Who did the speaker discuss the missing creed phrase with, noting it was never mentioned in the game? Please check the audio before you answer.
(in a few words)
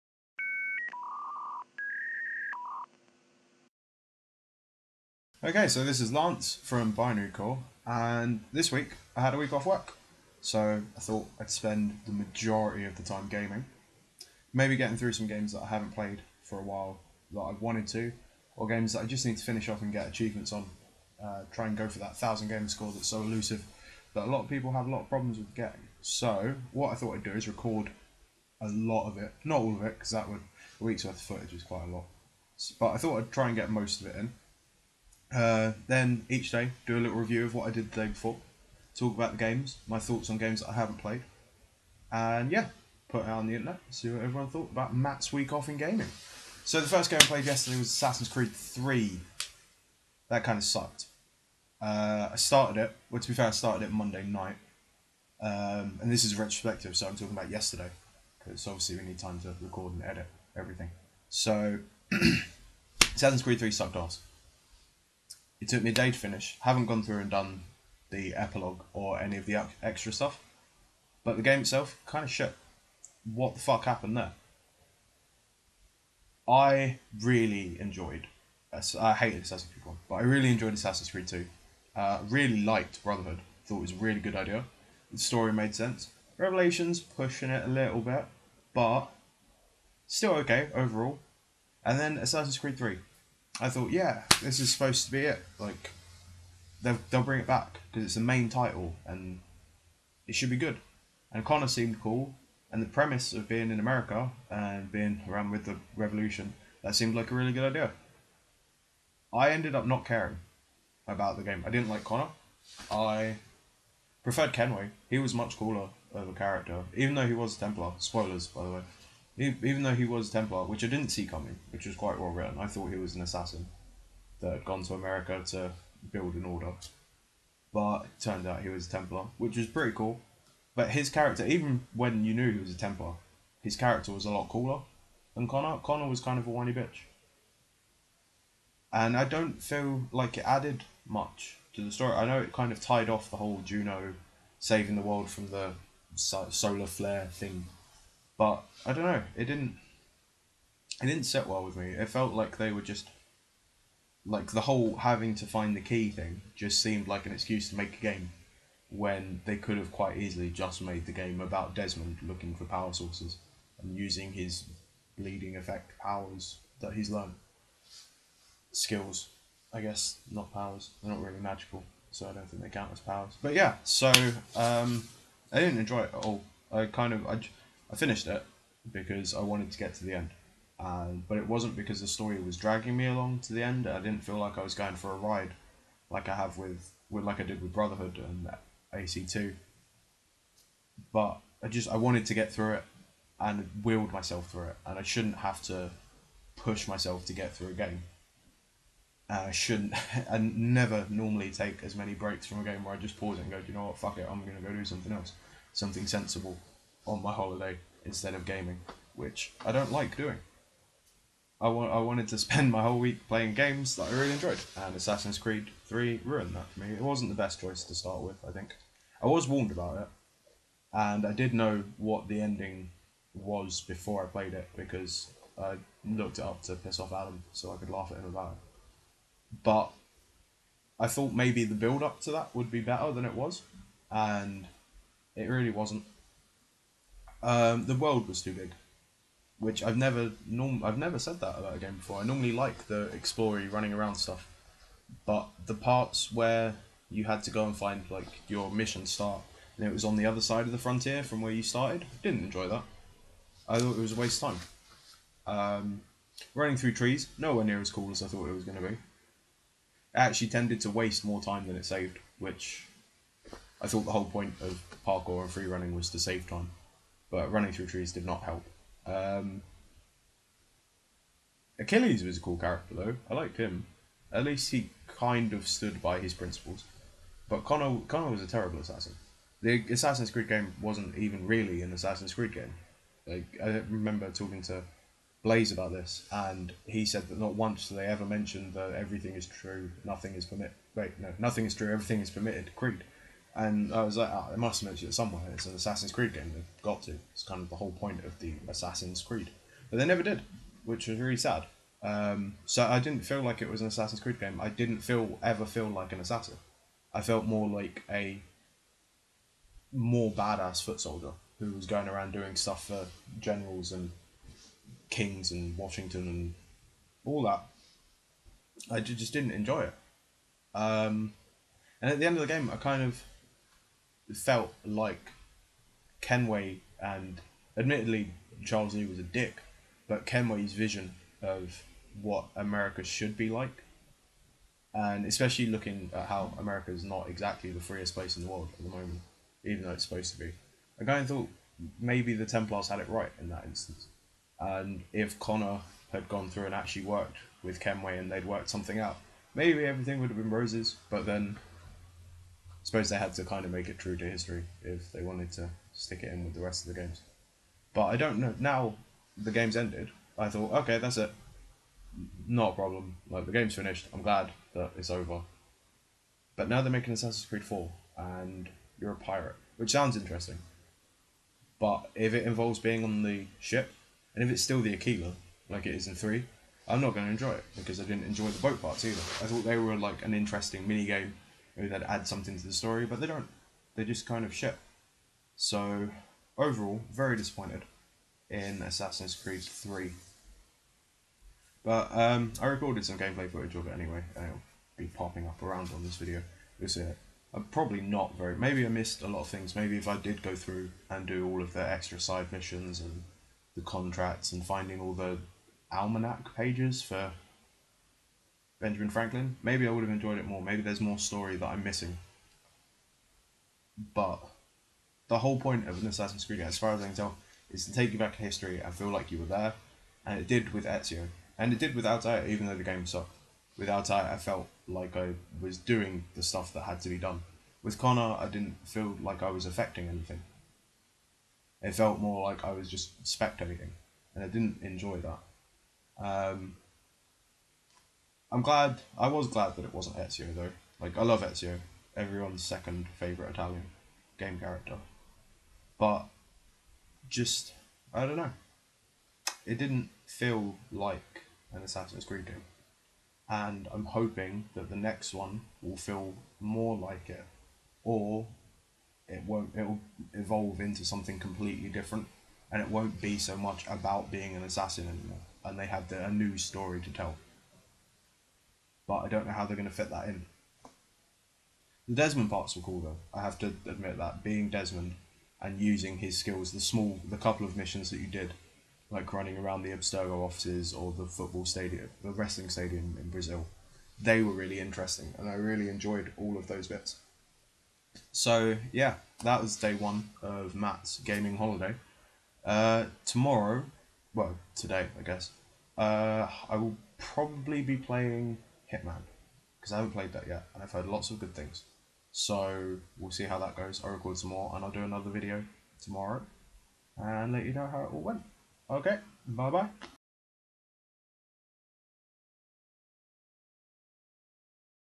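Blaze.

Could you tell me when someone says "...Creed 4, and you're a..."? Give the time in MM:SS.
06:07.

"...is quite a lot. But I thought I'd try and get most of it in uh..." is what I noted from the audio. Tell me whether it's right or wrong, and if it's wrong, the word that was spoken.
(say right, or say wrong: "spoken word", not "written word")
right.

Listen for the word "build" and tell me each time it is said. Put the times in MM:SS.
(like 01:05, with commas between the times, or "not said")
02:06, 03:51.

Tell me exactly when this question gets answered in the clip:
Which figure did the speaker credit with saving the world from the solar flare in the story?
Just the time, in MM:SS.
02:23.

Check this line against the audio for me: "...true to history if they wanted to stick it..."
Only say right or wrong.
right.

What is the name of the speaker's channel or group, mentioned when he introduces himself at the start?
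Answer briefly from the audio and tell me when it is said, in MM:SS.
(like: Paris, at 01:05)
Binary Core, at 00:06.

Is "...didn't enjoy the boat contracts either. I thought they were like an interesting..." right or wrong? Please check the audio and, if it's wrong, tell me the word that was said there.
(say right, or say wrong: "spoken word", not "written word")
wrong: "parts", not "contracts".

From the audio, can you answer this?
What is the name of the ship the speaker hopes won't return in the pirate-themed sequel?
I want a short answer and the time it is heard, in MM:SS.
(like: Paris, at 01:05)
Aquila, at 06:14.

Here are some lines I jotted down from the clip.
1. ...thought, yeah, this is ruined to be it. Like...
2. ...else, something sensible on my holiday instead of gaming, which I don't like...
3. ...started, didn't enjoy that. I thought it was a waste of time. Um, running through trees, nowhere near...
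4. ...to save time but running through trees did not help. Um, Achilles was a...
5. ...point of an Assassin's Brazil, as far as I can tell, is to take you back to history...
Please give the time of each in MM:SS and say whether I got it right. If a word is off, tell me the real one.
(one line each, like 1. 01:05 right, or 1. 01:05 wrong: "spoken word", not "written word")
1. 01:33 wrong: "supposed", not "ruined"
2. 03:25 right
3. 04:11 right
4. 04:26 right
5. 06:55 wrong: "Creed", not "Brazil".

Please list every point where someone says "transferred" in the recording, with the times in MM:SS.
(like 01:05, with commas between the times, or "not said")
not said.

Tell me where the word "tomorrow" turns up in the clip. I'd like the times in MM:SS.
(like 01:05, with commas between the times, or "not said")
08:13, 08:26.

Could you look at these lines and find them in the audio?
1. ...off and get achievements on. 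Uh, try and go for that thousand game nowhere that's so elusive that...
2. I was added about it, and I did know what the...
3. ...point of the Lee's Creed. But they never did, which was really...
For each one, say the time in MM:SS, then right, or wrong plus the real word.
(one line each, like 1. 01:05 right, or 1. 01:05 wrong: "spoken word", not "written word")
1. 00:19 wrong: "score", not "nowhere"
2. 03:39 wrong: "warned", not "added"
3. 04:57 wrong: "Assassin", not "Lee".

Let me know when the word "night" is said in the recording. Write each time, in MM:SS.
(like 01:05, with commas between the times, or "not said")
00:54.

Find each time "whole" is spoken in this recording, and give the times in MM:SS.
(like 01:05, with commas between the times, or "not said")
02:23, 02:34, 03:32, 04:24, 04:57, 06:55.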